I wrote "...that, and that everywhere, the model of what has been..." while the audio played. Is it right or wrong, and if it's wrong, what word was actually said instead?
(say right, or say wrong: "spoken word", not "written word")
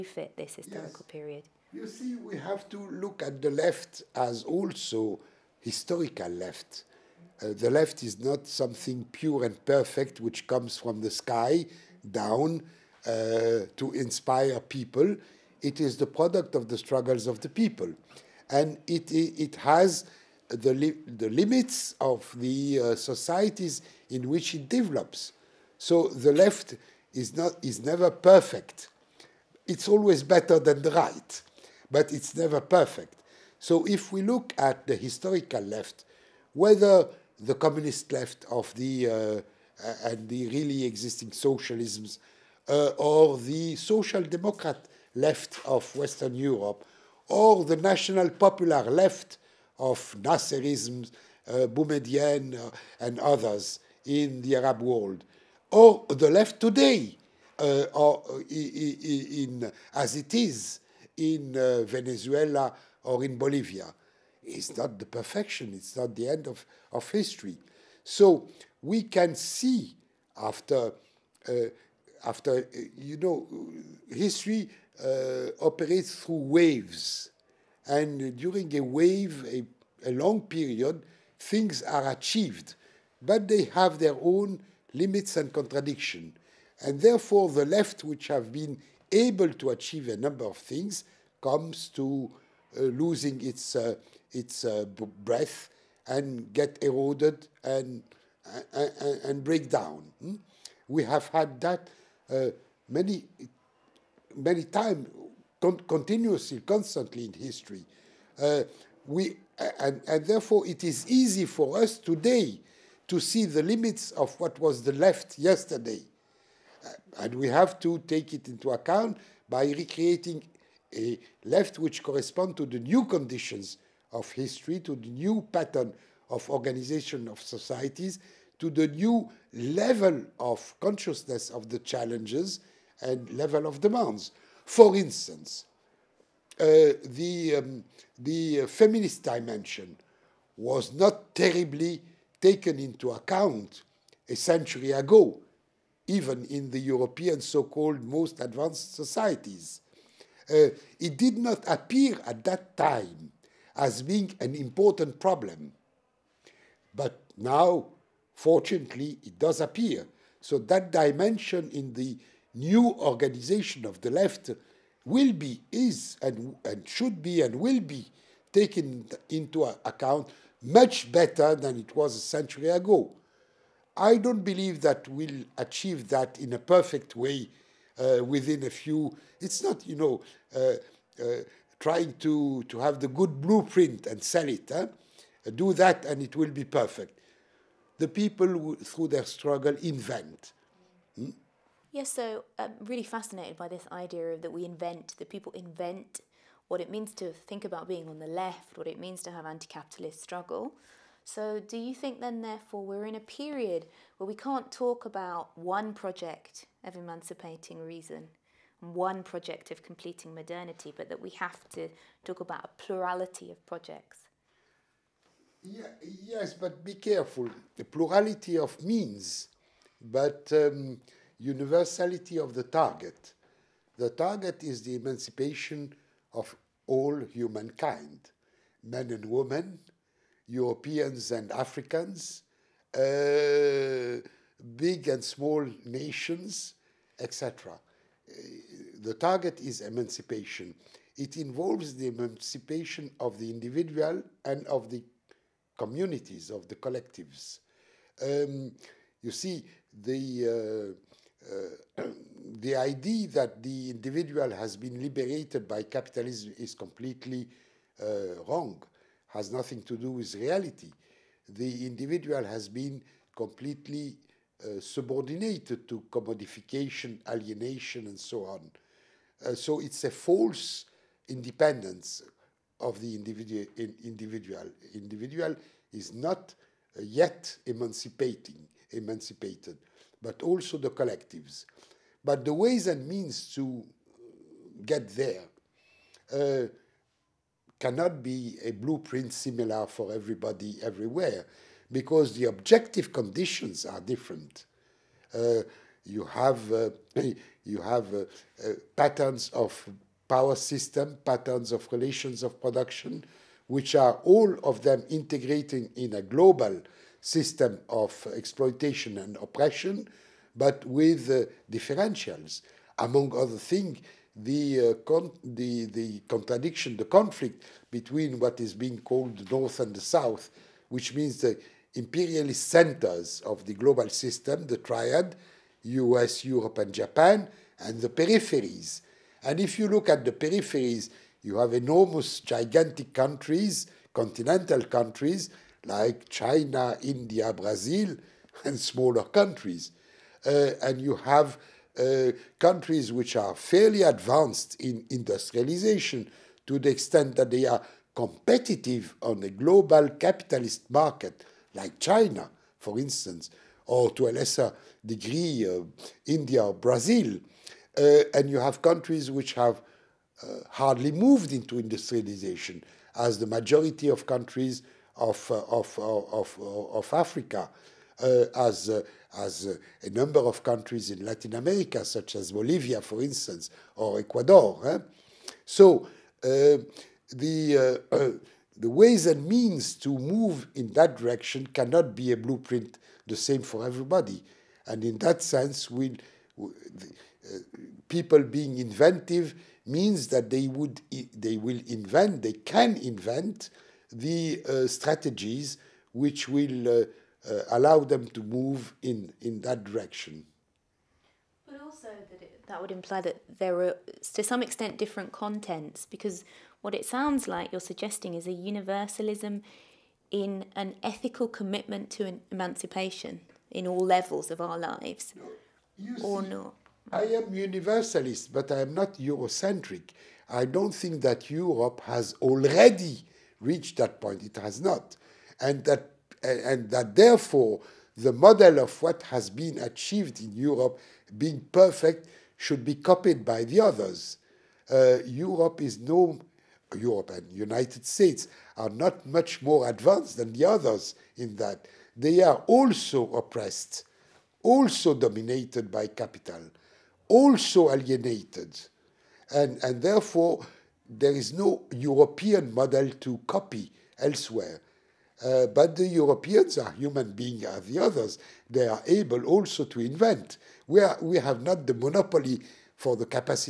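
wrong: "therefore", not "everywhere".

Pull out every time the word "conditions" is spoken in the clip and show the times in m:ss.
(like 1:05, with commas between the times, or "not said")
2:03, 4:53.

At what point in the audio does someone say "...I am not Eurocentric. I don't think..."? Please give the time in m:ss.
6:58.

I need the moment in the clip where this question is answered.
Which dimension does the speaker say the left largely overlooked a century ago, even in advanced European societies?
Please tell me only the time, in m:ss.
2:18.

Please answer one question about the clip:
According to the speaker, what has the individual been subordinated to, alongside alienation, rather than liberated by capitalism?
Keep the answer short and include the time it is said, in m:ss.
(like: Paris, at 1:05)
Commodification, at 4:26.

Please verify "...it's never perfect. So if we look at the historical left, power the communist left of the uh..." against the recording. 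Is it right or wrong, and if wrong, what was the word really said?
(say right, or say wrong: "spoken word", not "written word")
wrong: "whether", not "power".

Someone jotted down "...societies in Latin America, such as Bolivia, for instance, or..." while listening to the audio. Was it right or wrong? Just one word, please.
wrong.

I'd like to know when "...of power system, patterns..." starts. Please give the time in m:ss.
4:59.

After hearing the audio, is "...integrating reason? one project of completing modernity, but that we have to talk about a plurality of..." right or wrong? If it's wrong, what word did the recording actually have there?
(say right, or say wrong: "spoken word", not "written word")
wrong: "emancipating", not "integrating".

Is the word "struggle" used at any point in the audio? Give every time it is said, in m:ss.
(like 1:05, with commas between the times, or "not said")
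0:16, 3:09, 3:20.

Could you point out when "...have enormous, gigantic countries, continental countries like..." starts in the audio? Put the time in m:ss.
5:31.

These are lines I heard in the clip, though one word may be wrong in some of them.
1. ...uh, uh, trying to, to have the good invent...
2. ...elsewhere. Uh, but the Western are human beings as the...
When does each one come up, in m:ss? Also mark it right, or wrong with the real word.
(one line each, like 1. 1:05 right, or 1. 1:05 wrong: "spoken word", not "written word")
1. 3:00 wrong: "blueprint", not "invent"
2. 7:34 wrong: "Europeans", not "Western".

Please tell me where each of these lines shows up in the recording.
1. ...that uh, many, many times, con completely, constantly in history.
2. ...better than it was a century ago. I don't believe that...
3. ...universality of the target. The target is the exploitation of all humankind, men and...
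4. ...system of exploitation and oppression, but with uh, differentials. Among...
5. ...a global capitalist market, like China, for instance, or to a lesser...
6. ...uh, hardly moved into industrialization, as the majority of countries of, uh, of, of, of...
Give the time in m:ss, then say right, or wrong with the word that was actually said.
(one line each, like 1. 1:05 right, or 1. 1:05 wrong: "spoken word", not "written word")
1. 1:41 wrong: "continuously", not "completely"
2. 2:51 right
3. 3:41 wrong: "emancipation", not "exploitation"
4. 5:07 right
5. 5:49 right
6. 6:00 right.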